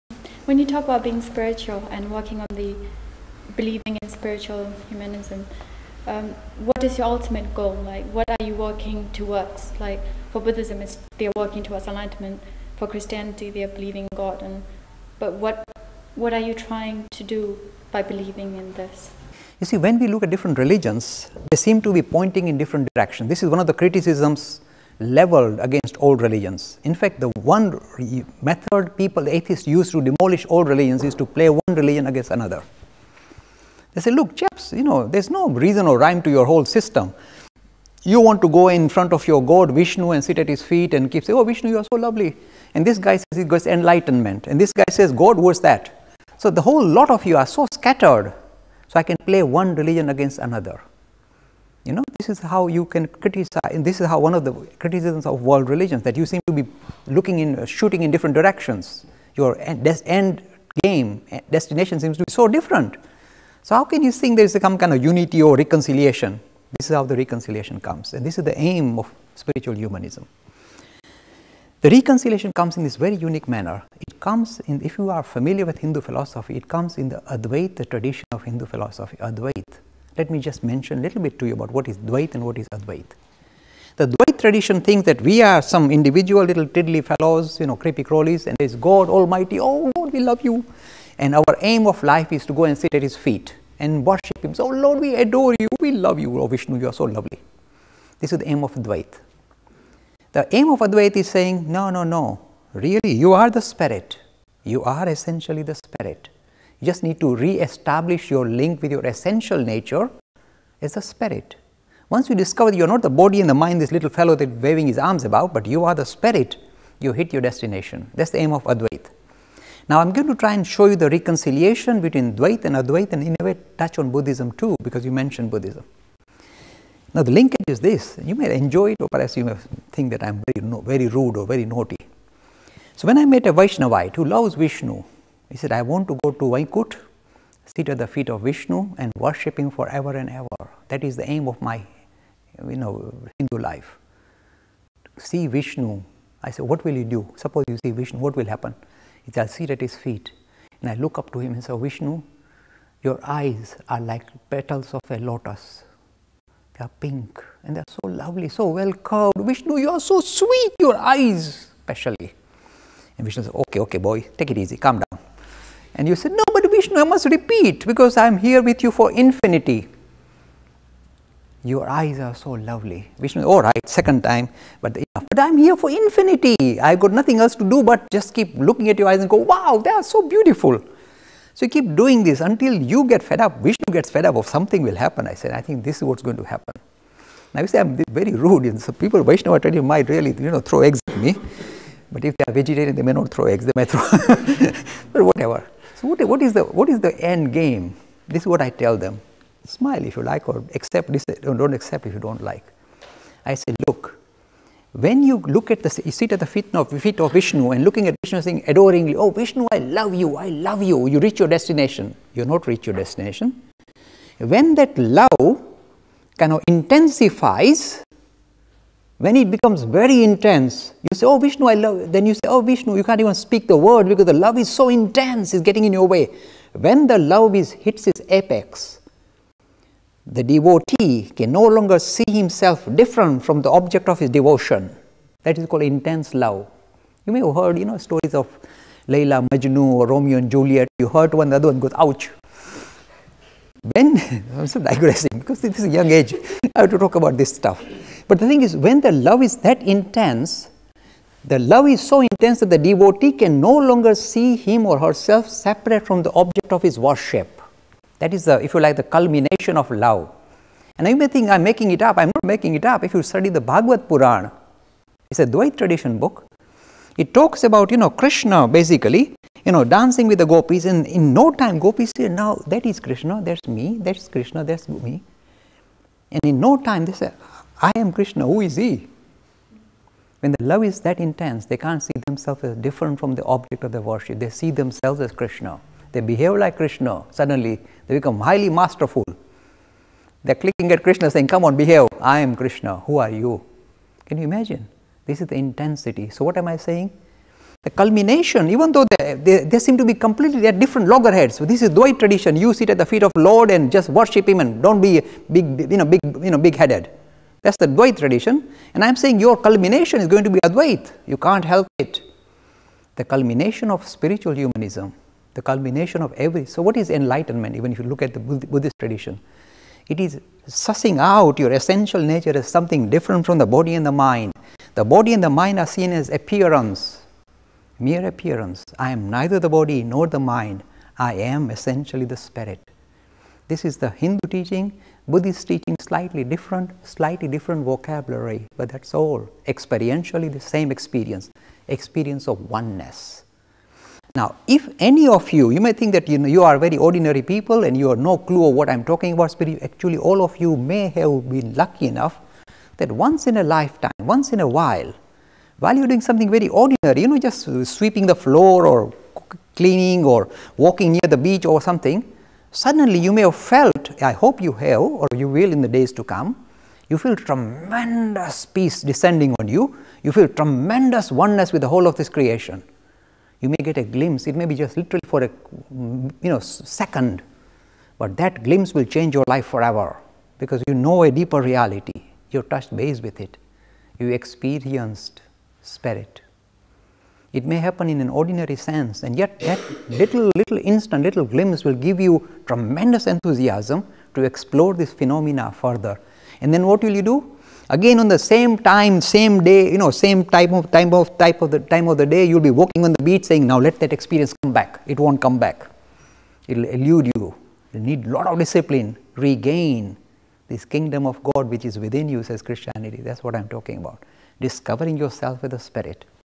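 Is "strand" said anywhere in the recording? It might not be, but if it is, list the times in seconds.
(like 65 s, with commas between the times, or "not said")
not said.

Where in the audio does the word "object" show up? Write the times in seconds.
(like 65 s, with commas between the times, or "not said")
233 s, 256 s, 283 s.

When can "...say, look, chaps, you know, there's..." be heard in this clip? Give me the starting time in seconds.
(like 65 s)
34 s.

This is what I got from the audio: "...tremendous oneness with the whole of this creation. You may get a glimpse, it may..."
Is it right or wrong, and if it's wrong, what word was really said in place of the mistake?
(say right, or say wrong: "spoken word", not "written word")
right.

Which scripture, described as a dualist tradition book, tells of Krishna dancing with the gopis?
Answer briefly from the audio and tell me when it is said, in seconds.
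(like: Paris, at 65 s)
Bhagavad Purana, at 263 s.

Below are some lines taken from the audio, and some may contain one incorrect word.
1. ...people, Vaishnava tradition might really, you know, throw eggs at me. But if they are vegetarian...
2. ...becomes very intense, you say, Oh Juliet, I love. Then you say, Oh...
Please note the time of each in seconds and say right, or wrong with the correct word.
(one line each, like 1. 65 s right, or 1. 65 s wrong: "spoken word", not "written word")
1. 188 s right
2. 219 s wrong: "Vishnu", not "Juliet".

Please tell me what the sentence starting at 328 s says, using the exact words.
I am neither the body nor the mind.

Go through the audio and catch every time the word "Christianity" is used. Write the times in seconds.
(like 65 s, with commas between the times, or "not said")
12 s, 412 s.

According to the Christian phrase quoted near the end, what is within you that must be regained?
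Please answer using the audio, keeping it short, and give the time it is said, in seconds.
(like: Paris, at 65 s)
Kingdom of God, at 410 s.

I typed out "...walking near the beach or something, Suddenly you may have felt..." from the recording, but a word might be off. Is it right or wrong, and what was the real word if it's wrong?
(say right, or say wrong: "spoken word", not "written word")
right.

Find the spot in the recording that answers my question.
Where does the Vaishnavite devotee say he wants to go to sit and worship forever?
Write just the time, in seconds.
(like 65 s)
136 s.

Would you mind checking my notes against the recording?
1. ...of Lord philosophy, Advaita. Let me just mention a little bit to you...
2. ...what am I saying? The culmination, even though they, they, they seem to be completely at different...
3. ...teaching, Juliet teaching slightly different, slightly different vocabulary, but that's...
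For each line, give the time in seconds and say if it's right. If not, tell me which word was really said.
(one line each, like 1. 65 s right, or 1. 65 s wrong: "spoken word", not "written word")
1. 78 s wrong: "Hindu", not "Lord"
2. 296 s right
3. 334 s wrong: "Buddhist", not "Juliet".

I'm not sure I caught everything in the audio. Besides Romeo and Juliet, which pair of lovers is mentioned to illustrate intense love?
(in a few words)
Leila Majnu.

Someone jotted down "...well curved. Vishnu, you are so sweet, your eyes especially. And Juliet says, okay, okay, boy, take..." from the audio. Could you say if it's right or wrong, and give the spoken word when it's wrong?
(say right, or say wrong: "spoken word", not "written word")
wrong: "Vishnu", not "Juliet".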